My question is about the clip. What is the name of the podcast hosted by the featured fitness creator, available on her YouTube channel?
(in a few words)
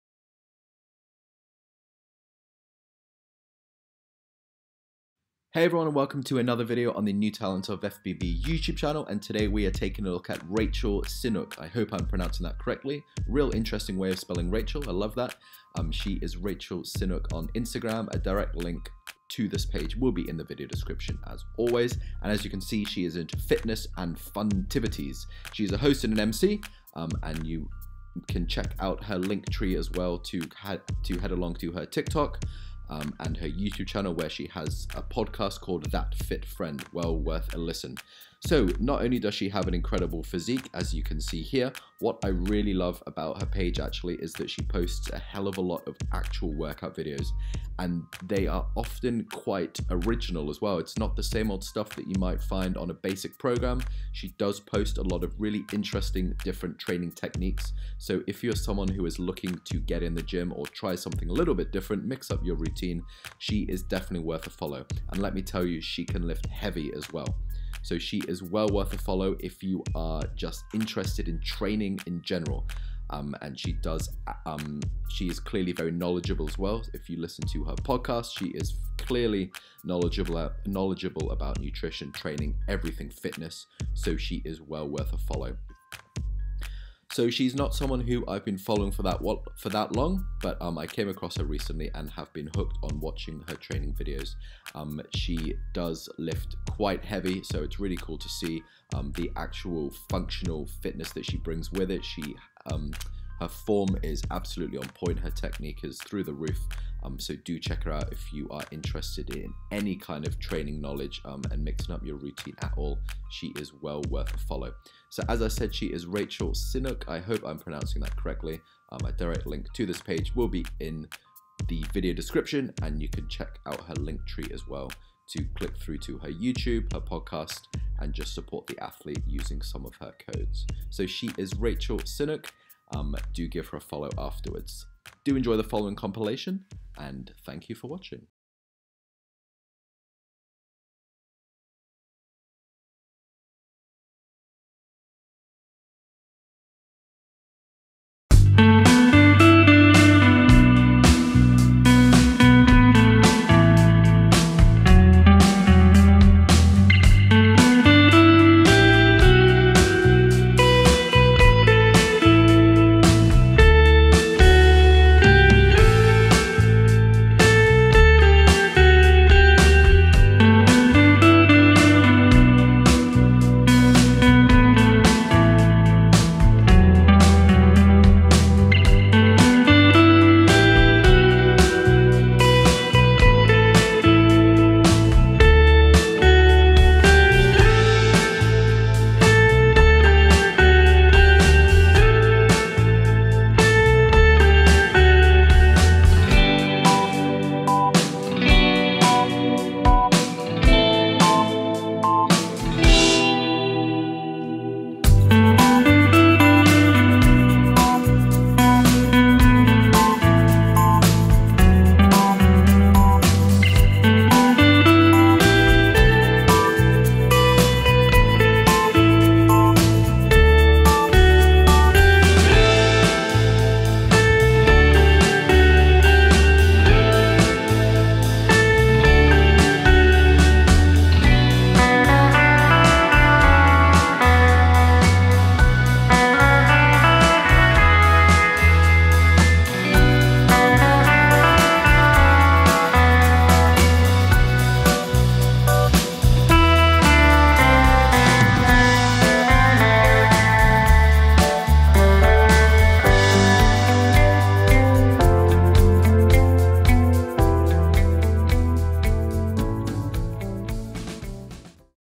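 That Fit Friend.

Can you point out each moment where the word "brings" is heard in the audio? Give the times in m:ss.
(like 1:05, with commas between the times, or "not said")
1:41.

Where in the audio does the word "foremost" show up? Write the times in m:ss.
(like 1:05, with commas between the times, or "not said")
not said.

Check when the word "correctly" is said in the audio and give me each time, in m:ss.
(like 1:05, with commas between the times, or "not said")
0:12, 1:58.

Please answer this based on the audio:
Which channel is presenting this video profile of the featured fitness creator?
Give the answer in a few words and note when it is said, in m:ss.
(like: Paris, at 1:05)
New Talent of FBB, at 0:07.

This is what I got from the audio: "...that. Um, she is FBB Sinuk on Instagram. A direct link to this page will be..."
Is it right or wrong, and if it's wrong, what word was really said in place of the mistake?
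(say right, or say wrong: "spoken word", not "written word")
wrong: "Raechel", not "FBB".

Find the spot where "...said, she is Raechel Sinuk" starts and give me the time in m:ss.
1:55.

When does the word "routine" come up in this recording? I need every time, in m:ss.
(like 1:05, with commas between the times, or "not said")
1:02, 1:52.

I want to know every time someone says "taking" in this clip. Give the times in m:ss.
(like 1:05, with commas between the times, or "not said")
0:09.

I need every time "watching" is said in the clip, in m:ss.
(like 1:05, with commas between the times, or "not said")
1:33, 2:17.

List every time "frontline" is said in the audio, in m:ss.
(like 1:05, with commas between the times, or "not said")
not said.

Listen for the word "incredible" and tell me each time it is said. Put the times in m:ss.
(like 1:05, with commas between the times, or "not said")
0:39.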